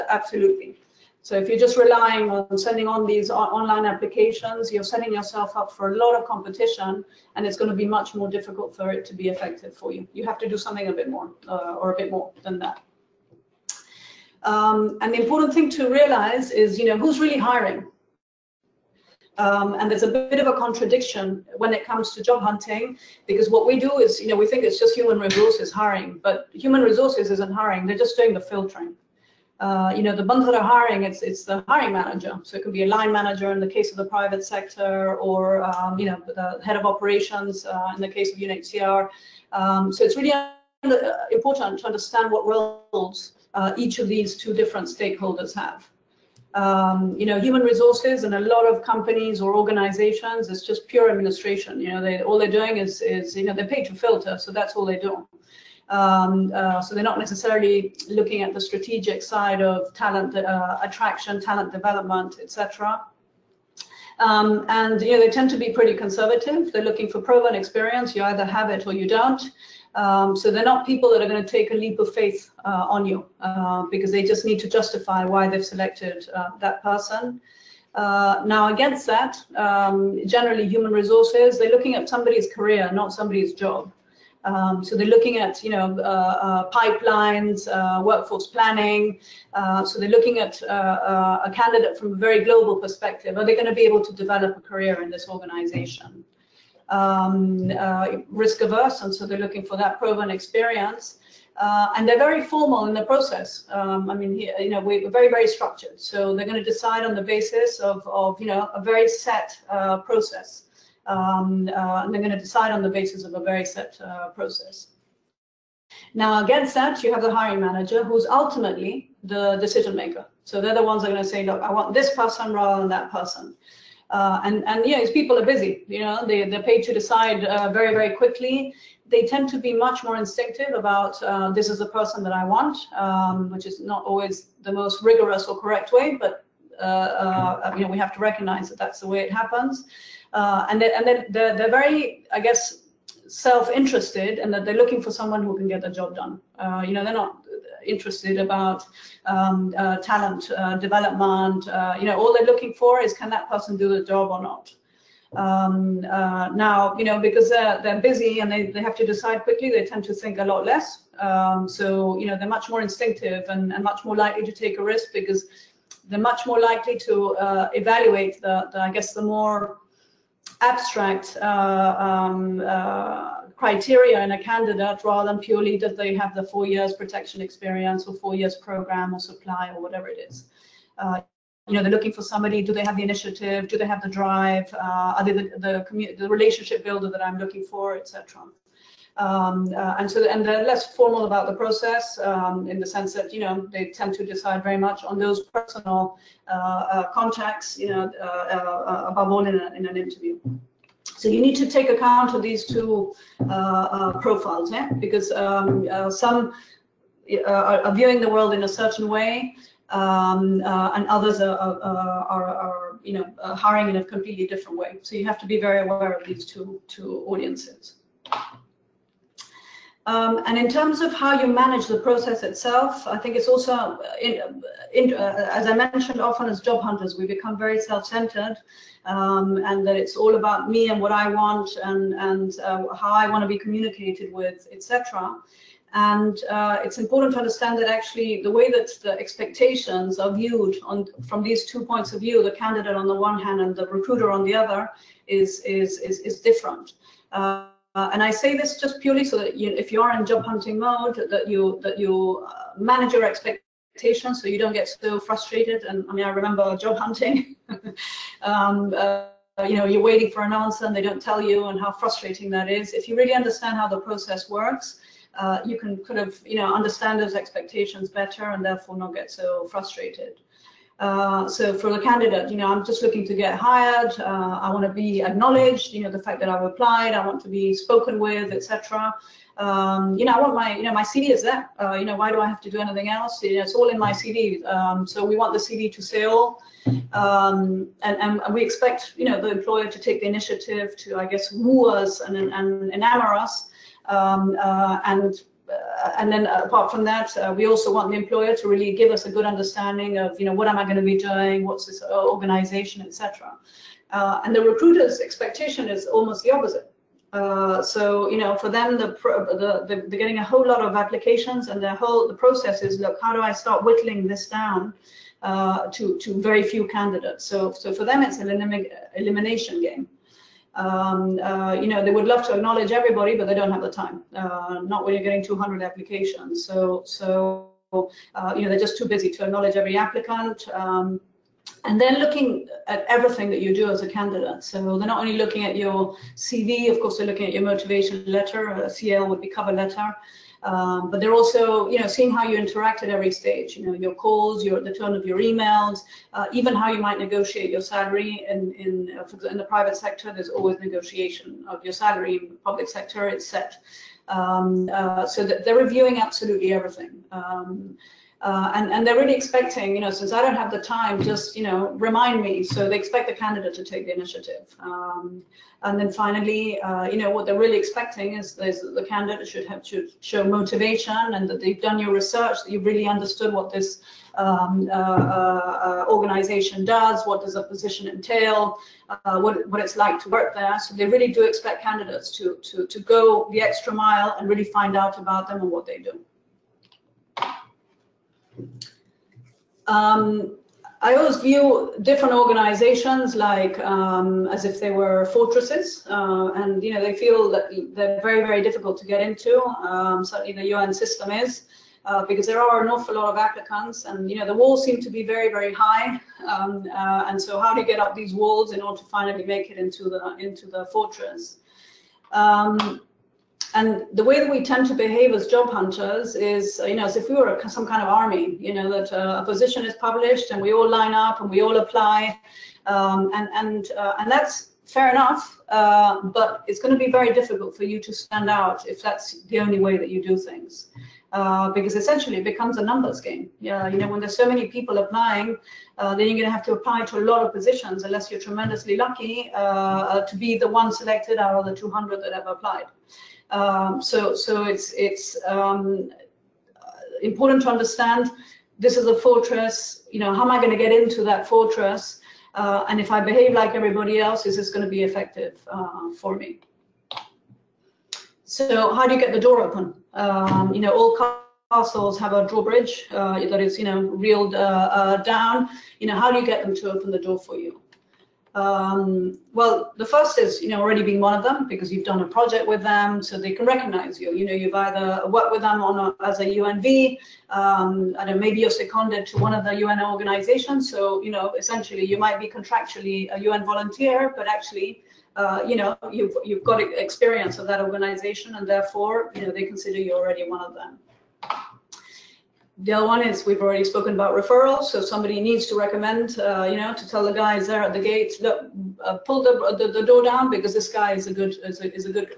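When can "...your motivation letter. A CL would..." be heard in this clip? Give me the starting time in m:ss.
5:37.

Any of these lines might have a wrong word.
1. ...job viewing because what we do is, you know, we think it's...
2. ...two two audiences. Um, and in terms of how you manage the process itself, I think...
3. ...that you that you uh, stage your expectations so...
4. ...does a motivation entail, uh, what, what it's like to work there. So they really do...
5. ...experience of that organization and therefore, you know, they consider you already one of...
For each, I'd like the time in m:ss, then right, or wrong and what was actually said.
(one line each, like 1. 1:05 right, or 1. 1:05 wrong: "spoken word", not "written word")
1. 0:22 wrong: "hunting", not "viewing"
2. 3:36 right
3. 4:11 wrong: "manage", not "stage"
4. 6:17 wrong: "position", not "motivation"
5. 8:06 right.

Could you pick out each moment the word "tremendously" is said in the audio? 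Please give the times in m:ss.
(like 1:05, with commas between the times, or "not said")
7:18.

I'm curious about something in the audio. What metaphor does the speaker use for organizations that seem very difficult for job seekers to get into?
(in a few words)
Fortresses.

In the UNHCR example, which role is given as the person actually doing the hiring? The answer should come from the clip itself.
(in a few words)
Head of operations.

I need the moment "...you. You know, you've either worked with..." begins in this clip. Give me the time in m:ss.
7:54.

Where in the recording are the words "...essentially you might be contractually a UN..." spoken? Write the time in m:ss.
8:01.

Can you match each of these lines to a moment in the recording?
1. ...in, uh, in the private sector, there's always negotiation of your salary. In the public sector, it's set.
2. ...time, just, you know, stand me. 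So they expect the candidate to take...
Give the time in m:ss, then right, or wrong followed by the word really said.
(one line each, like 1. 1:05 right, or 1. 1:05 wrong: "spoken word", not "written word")
1. 5:48 right
2. 6:00 wrong: "remind", not "stand".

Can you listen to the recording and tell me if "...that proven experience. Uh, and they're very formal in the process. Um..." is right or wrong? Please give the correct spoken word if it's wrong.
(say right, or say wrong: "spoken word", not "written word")
right.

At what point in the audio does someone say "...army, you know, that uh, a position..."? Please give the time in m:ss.
6:58.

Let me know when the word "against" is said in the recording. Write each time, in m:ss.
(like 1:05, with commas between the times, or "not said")
1:18, 1:56.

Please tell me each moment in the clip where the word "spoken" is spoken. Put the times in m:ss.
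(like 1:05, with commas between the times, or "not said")
4:37, 8:13.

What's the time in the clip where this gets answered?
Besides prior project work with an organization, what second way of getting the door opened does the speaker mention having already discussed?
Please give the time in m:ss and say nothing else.
8:14.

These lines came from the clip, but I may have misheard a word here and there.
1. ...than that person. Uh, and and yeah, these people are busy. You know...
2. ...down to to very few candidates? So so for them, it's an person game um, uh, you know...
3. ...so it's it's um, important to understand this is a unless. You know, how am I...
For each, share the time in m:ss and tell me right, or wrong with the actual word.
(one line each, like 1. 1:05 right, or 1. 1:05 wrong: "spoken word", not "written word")
1. 2:02 right
2. 5:14 wrong: "elimination", not "person"
3. 7:24 wrong: "fortress", not "unless".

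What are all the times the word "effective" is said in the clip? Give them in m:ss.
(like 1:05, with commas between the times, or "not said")
0:09, 7:35.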